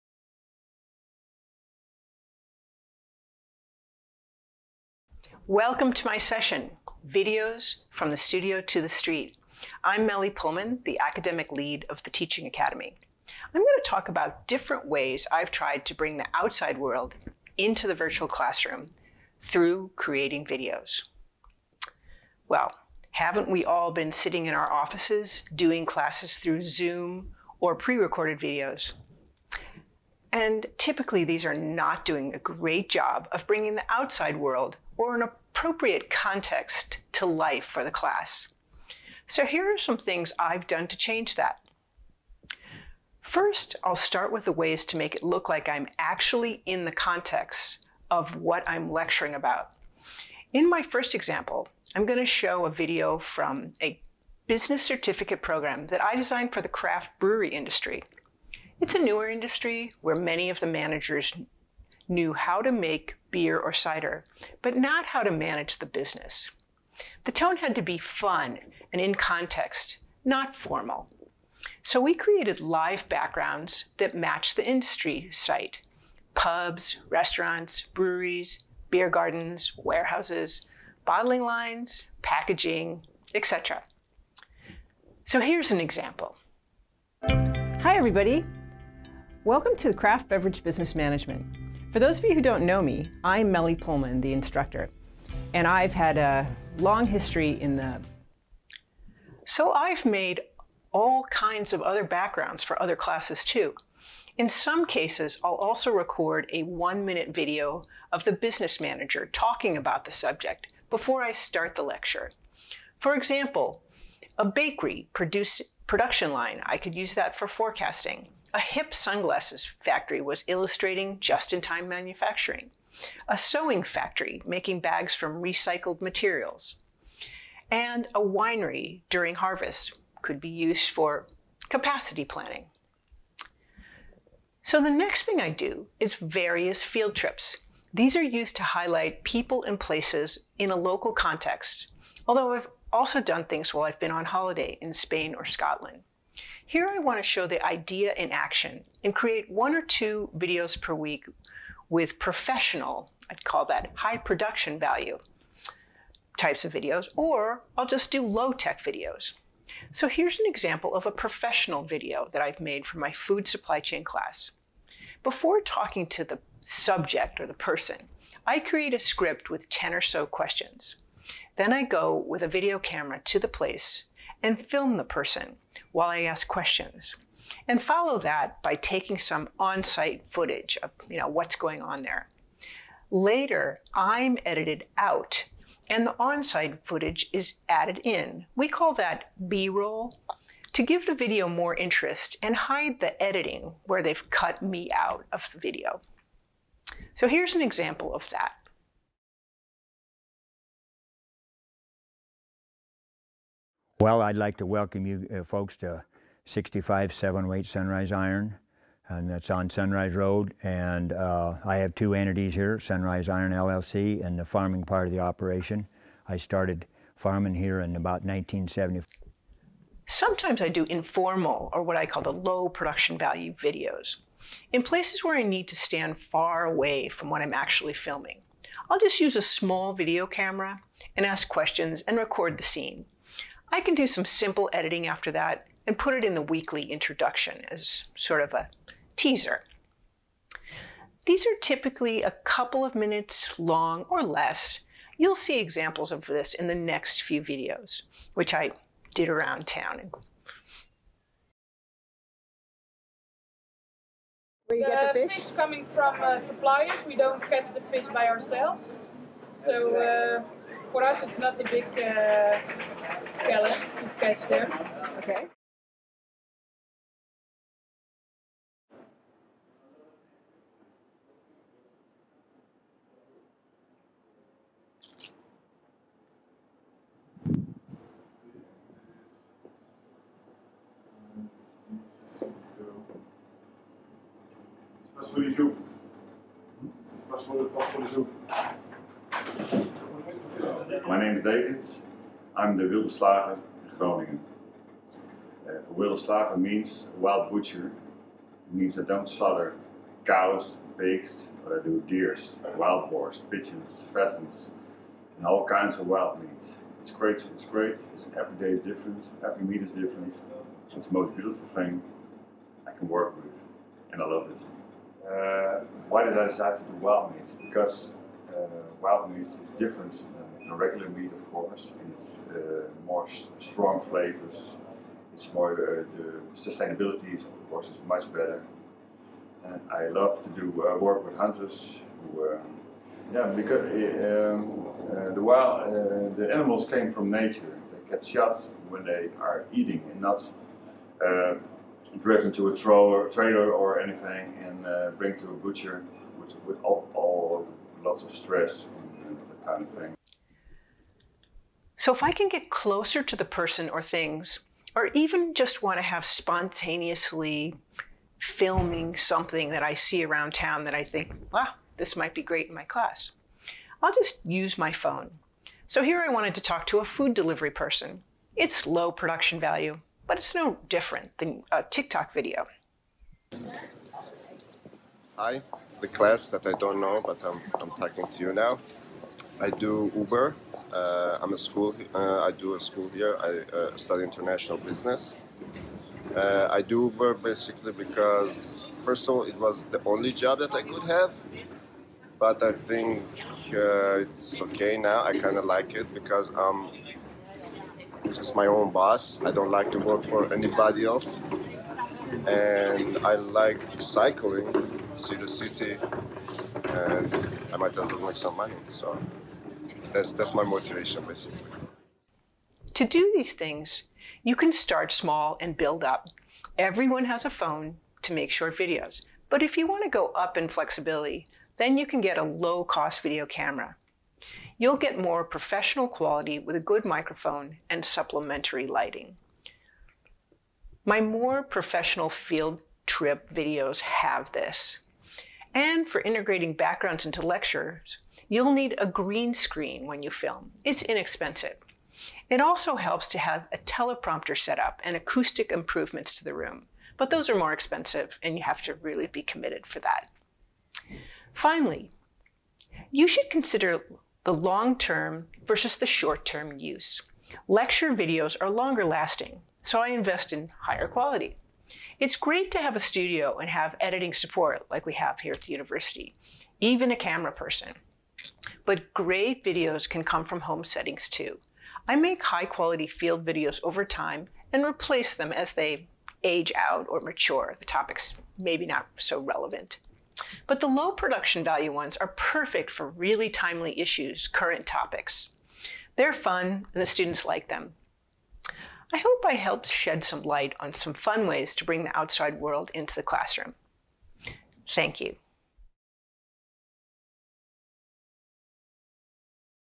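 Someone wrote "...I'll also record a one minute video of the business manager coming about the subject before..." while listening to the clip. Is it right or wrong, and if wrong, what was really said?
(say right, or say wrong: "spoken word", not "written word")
wrong: "talking", not "coming".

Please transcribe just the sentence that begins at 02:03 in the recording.
A sewing factory making bags from recycled materials.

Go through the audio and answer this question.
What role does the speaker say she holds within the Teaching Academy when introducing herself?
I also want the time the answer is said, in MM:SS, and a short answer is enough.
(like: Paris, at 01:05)
academic lead, at 00:10.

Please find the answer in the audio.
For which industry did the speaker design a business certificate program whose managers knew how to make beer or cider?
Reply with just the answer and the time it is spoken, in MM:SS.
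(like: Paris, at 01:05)
craft brewery, at 00:56.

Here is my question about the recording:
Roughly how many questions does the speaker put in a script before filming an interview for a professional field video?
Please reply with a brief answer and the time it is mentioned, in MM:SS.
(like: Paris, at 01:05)
10, at 02:49.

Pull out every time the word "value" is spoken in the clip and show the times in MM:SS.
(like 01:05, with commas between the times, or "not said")
02:34, 03:43, 06:09, 08:01.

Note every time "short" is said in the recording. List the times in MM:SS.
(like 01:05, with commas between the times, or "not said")
06:58, 07:36.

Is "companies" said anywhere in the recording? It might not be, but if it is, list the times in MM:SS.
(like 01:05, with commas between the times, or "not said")
not said.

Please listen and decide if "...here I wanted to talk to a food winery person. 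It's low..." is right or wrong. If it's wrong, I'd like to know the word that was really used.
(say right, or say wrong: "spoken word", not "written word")
wrong: "delivery", not "winery".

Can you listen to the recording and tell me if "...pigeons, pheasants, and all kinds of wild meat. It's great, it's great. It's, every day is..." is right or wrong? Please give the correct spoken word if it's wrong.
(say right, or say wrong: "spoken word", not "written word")
right.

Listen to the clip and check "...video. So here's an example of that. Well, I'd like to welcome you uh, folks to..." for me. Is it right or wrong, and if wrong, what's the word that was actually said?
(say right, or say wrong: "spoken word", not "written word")
right.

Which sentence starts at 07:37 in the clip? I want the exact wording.
Lecture videos are longer lasting, so I invest in higher quality.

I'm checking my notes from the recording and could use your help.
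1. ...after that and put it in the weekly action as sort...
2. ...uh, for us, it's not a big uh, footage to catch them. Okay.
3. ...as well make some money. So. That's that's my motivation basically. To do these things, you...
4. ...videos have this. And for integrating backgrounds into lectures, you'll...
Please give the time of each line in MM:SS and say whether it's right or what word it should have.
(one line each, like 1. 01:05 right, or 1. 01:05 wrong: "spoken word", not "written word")
1. 03:55 wrong: "introduction", not "action"
2. 04:19 wrong: "challenge", not "footage"
3. 06:47 right
4. 07:13 right.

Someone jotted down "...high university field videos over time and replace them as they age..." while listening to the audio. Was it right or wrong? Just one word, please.
wrong.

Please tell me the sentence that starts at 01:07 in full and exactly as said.
The tone had to be fun and in context, not formal.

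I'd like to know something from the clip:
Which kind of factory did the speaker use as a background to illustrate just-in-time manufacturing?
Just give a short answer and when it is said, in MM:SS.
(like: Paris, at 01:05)
hip sunglasses factory, at 01:58.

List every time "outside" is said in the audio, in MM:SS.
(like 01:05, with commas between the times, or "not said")
00:16, 00:33, 08:12.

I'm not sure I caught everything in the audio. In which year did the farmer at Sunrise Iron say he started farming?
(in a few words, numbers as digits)
1970.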